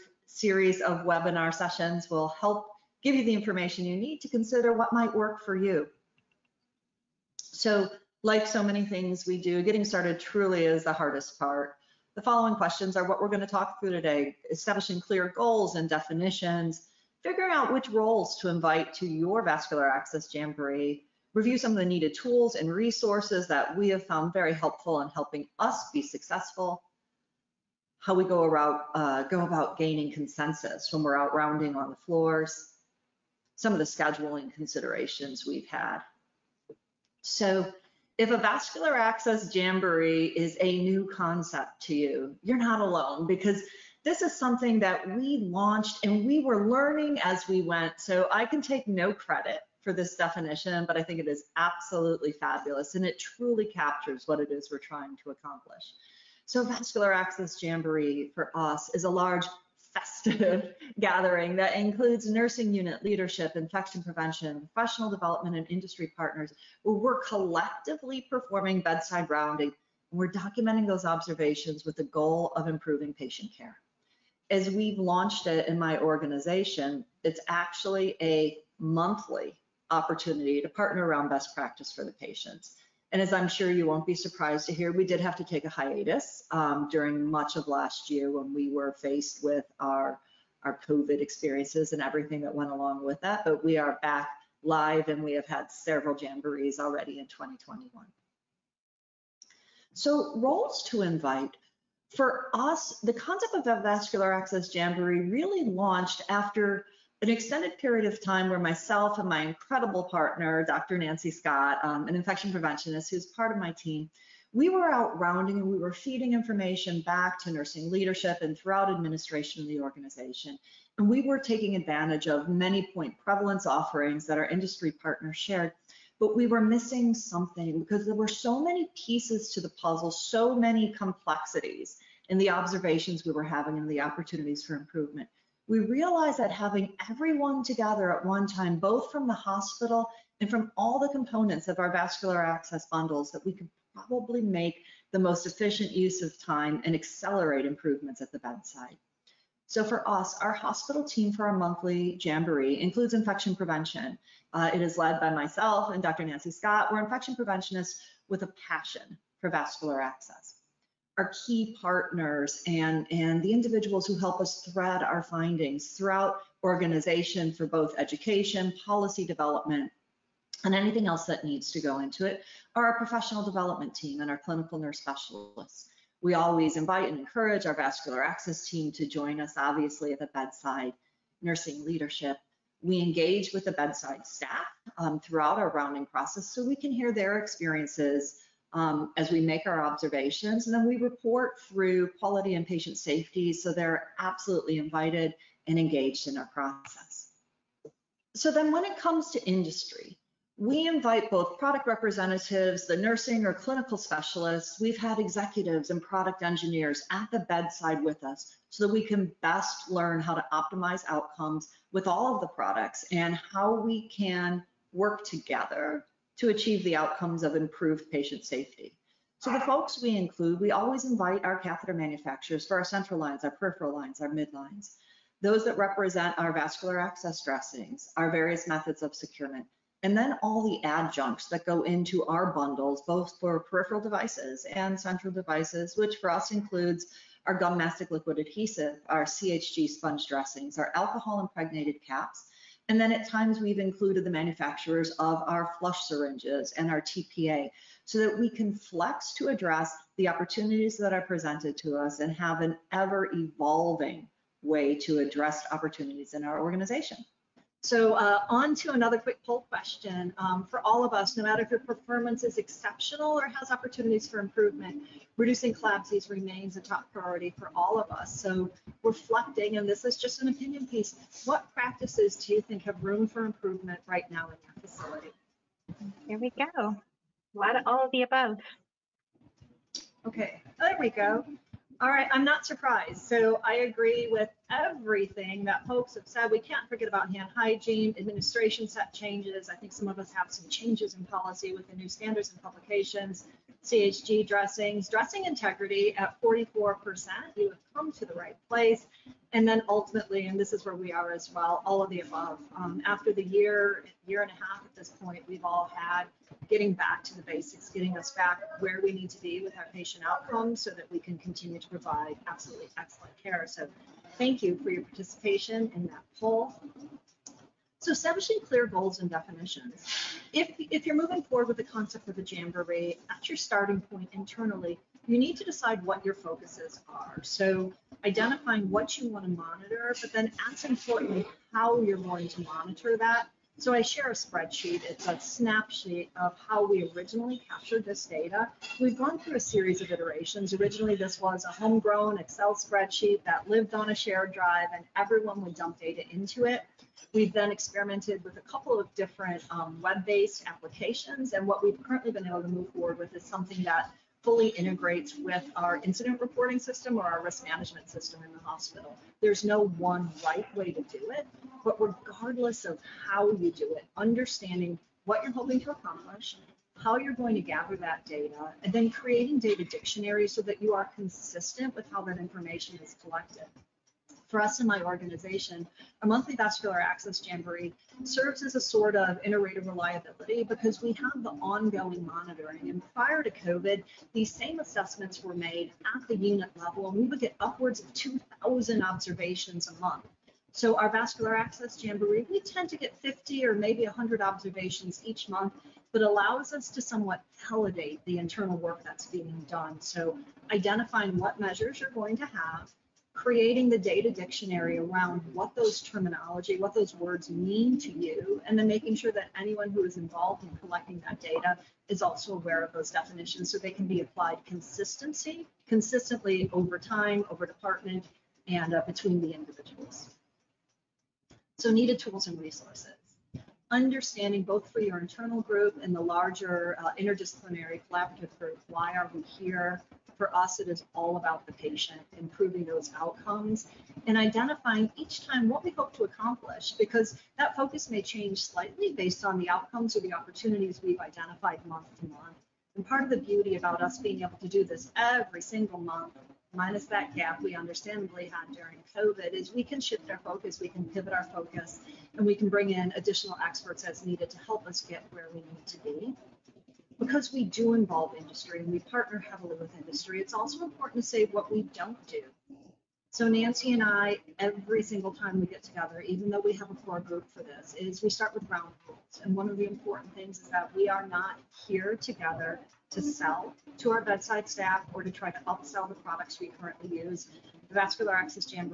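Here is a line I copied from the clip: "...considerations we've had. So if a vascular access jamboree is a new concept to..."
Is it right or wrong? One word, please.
right.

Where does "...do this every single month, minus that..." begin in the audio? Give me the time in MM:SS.
07:24.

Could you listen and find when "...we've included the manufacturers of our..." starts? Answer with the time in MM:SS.
04:03.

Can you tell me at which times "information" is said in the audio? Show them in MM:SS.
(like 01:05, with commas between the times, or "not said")
00:03, 01:56, 06:12.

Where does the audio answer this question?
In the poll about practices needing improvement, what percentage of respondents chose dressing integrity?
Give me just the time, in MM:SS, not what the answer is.
04:56.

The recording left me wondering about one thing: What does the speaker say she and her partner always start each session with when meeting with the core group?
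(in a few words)
ground rules.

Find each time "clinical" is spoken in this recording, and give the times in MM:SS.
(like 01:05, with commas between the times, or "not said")
02:54, 03:23.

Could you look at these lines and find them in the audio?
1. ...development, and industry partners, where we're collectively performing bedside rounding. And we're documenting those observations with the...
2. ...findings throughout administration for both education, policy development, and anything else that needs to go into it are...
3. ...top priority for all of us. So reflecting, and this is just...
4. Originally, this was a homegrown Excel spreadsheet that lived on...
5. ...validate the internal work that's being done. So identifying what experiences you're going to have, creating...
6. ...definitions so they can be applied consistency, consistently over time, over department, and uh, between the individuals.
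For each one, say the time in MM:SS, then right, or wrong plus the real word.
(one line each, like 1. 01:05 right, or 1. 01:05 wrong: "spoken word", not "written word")
1. 01:05 right
2. 02:45 wrong: "organization", not "administration"
3. 04:26 right
4. 05:40 right
5. 06:37 wrong: "measures", not "experiences"
6. 06:53 right.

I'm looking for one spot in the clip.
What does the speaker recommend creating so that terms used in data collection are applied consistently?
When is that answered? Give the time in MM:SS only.
06:09.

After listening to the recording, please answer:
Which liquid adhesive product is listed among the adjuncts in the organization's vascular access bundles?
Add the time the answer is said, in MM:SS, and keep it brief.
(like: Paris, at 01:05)
gum mastic, at 03:57.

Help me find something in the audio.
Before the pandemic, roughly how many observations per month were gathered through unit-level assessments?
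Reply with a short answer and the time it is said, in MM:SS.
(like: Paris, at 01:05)
2,000, at 06:28.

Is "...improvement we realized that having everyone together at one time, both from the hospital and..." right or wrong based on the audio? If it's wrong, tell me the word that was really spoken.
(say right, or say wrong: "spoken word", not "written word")
right.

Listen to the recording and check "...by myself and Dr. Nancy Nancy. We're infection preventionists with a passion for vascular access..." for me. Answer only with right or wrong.
wrong.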